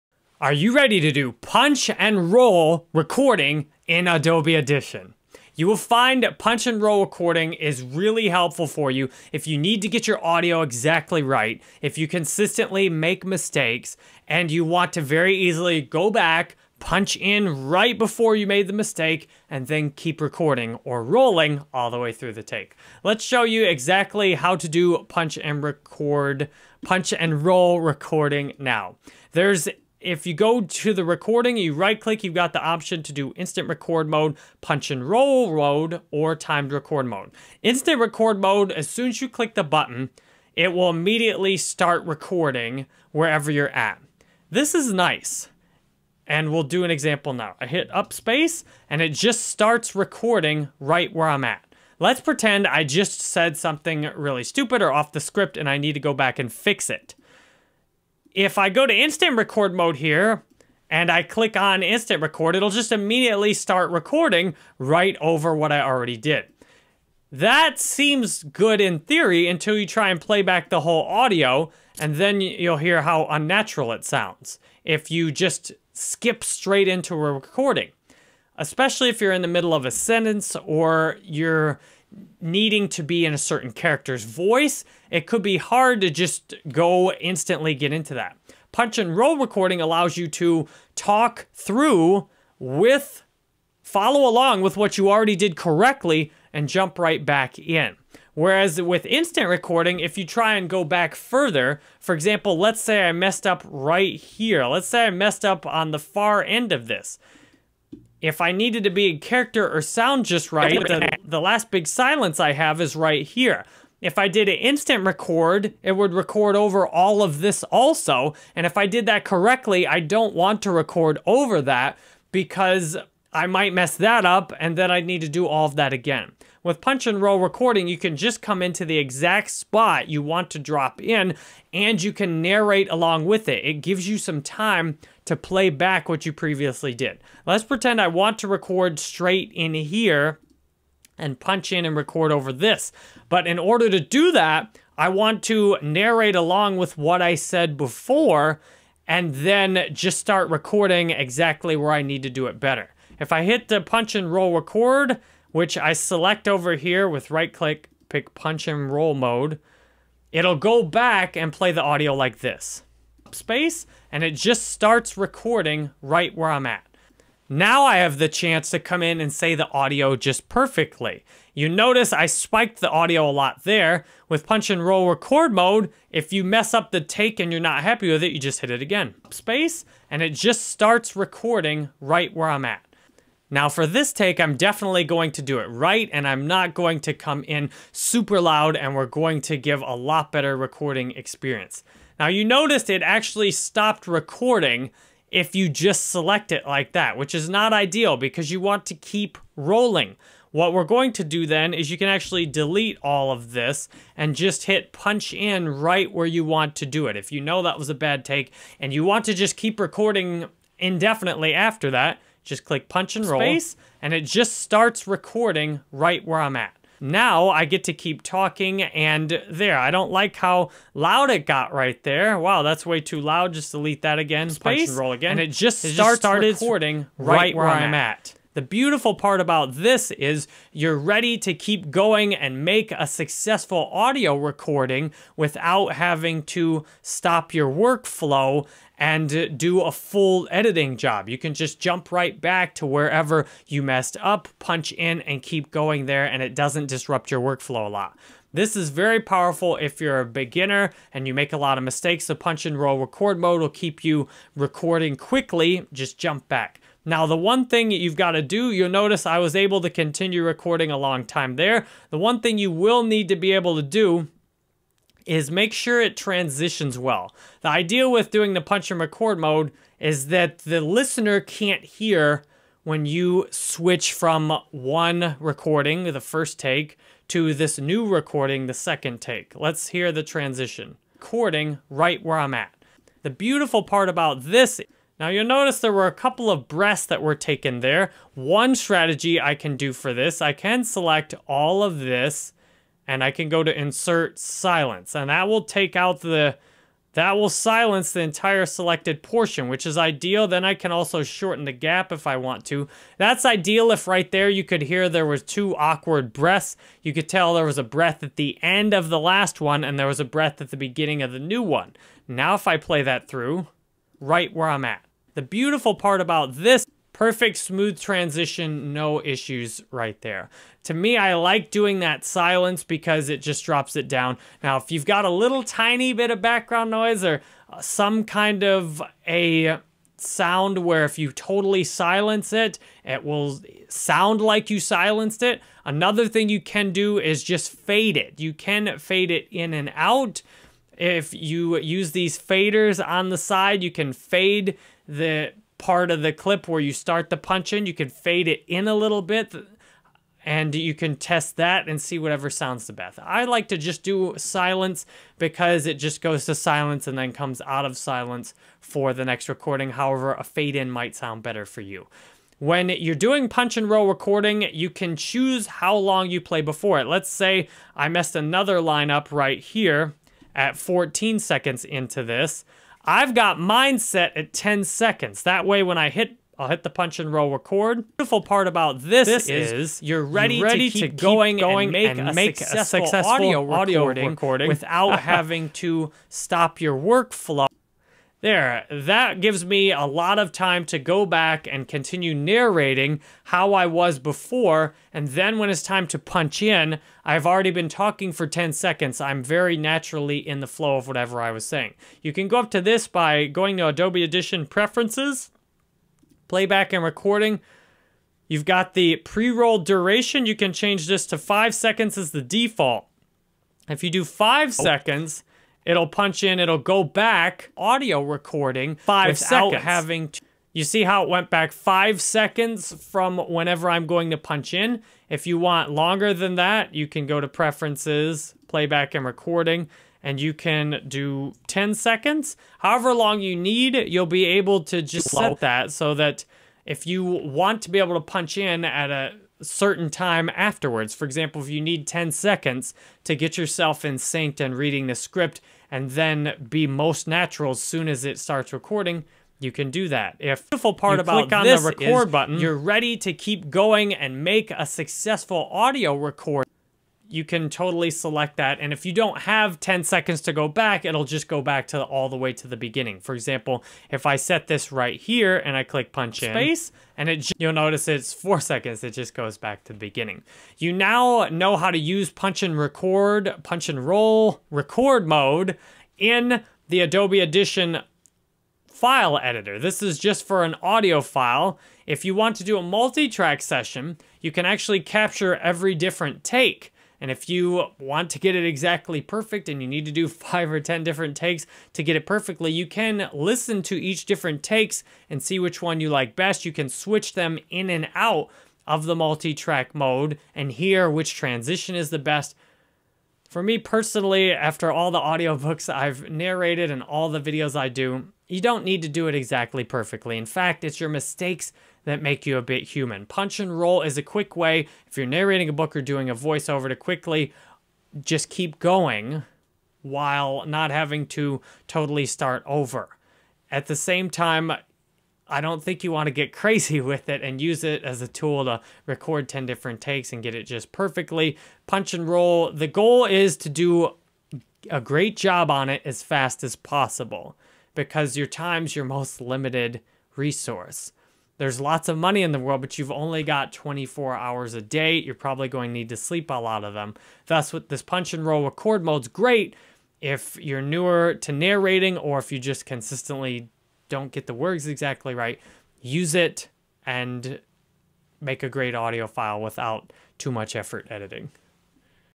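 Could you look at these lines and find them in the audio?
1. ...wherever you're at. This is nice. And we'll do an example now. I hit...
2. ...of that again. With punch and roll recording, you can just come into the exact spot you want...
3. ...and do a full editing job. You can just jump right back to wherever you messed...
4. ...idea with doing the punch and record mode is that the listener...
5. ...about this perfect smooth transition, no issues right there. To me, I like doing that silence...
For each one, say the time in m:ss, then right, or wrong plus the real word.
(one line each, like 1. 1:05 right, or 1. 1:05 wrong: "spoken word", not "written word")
1. 0:43 right
2. 2:05 right
3. 3:59 right
4. 4:27 right
5. 5:16 right.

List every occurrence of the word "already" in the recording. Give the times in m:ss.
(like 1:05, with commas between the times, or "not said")
1:05, 1:35, 6:37.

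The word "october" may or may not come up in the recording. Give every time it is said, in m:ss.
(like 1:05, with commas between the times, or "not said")
not said.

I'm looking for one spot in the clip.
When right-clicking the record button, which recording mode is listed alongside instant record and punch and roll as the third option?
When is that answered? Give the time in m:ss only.
0:36.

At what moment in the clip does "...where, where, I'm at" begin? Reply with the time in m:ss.
3:47.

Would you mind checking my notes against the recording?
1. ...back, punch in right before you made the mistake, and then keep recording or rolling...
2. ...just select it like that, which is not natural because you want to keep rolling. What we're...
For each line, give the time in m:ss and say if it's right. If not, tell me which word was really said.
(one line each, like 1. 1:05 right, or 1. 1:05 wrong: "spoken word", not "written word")
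1. 0:16 right
2. 3:15 wrong: "ideal", not "natural".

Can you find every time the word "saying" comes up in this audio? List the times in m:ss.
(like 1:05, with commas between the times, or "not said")
6:41.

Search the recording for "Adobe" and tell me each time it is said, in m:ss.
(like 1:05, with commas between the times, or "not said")
0:04, 6:43, 7:56.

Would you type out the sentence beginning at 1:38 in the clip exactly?
Whereas with instant recording, if you try and go back further, for example, let's say I messed up right here.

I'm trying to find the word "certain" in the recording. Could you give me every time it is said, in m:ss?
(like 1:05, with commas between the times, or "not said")
1:23, 7:19.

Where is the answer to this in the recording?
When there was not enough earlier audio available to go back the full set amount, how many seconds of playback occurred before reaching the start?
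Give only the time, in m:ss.
7:48.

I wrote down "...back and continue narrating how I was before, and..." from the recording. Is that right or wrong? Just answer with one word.
right.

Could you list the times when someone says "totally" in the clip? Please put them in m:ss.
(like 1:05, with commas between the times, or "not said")
5:31, 7:37, 8:41.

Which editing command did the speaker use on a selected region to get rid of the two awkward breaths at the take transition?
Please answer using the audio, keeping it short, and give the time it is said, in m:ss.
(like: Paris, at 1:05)
Insert silence, at 4:53.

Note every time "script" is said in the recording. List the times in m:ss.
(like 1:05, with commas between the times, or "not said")
0:55, 7:25.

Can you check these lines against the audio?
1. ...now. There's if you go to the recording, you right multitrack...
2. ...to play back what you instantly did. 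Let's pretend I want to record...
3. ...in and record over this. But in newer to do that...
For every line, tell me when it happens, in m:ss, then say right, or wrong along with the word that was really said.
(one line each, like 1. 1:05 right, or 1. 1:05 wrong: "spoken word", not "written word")
1. 0:28 wrong: "click", not "multitrack"
2. 2:15 wrong: "previously", not "instantly"
3. 2:21 wrong: "order", not "newer".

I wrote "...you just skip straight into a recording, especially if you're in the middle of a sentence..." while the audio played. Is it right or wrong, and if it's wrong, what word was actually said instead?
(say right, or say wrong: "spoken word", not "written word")
right.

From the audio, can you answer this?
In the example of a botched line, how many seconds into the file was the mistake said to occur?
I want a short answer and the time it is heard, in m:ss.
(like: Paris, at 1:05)
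14, at 6:10.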